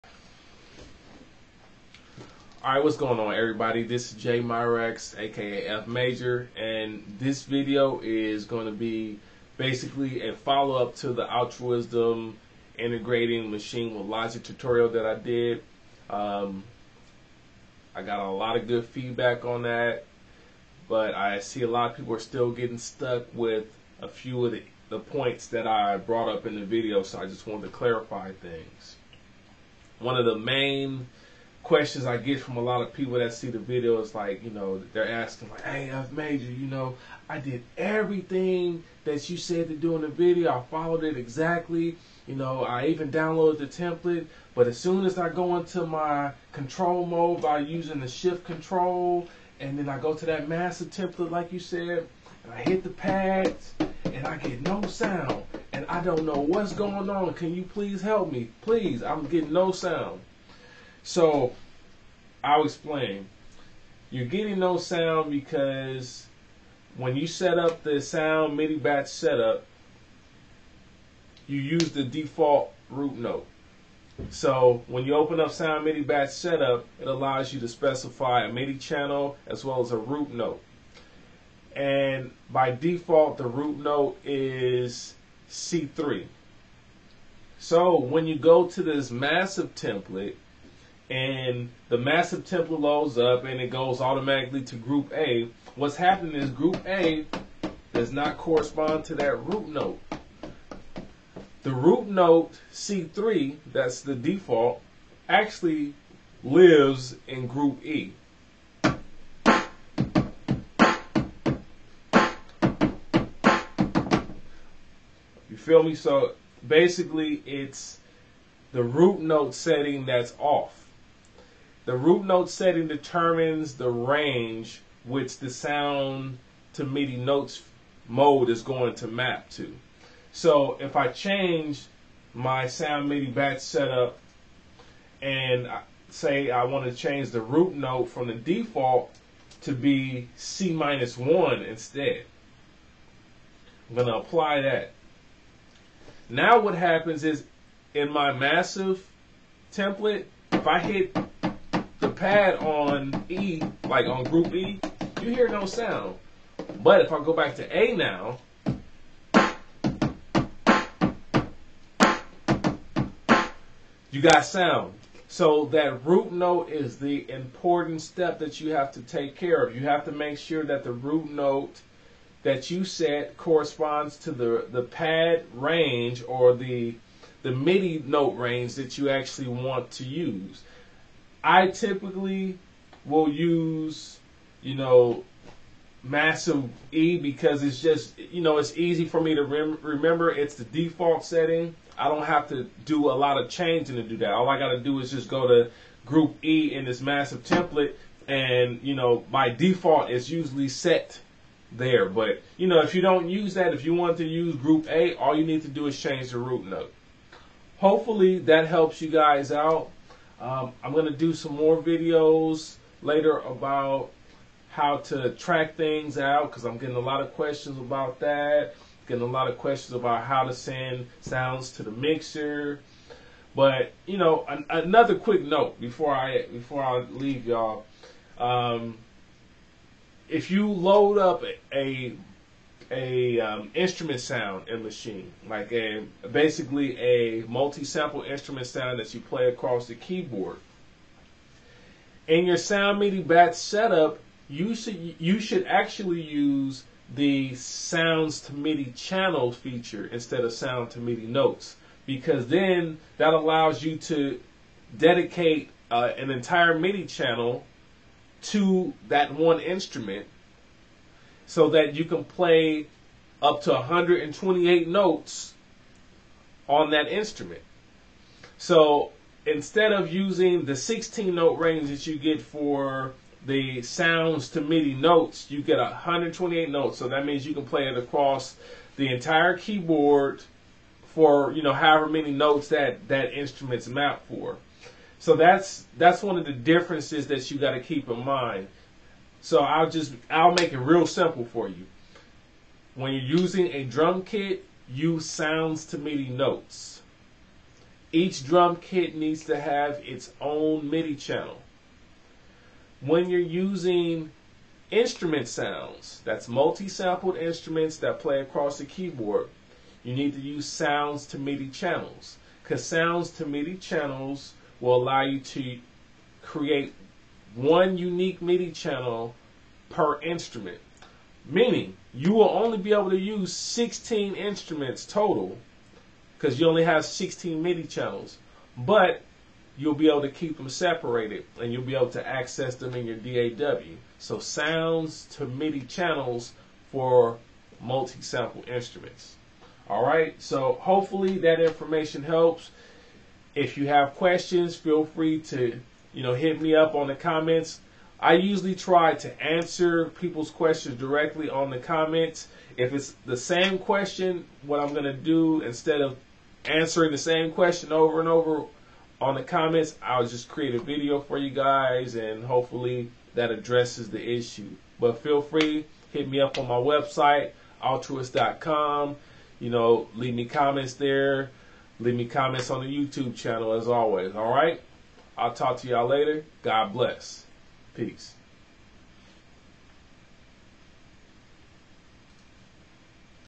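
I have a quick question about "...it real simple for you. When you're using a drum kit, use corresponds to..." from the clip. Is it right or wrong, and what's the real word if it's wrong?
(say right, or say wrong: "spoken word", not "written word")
wrong: "sounds", not "corresponds".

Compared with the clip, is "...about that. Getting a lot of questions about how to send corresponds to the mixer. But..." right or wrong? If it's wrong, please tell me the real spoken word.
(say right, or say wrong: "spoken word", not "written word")
wrong: "sounds", not "corresponds".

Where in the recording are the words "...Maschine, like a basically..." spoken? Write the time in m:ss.
3:54.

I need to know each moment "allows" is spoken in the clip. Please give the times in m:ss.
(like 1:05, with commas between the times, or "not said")
1:17, 4:13, 5:15.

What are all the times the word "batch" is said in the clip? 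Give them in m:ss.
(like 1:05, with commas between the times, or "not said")
1:08, 1:16, 2:13, 4:03.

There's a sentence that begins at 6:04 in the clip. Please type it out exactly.
But feel free, hit me up on my website, altruwest.com.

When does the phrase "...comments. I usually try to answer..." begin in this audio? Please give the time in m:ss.
5:47.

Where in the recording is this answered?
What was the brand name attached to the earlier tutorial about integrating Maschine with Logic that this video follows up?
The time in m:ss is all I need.
0:11.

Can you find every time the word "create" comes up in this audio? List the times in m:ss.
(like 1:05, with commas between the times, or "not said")
5:16, 6:00.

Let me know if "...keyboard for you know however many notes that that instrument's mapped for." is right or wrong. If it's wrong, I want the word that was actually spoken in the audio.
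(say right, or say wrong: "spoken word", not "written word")
right.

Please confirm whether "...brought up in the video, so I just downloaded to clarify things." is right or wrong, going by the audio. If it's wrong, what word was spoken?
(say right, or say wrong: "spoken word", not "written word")
wrong: "wanted", not "downloaded".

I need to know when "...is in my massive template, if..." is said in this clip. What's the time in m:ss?
2:27.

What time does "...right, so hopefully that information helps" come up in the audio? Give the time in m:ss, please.
5:40.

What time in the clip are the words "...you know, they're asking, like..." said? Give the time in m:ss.
0:34.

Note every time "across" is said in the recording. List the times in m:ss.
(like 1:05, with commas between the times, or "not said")
3:59, 4:37, 5:08.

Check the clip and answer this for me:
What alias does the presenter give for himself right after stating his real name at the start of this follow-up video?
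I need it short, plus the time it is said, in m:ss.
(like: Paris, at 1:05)
F Major, at 0:05.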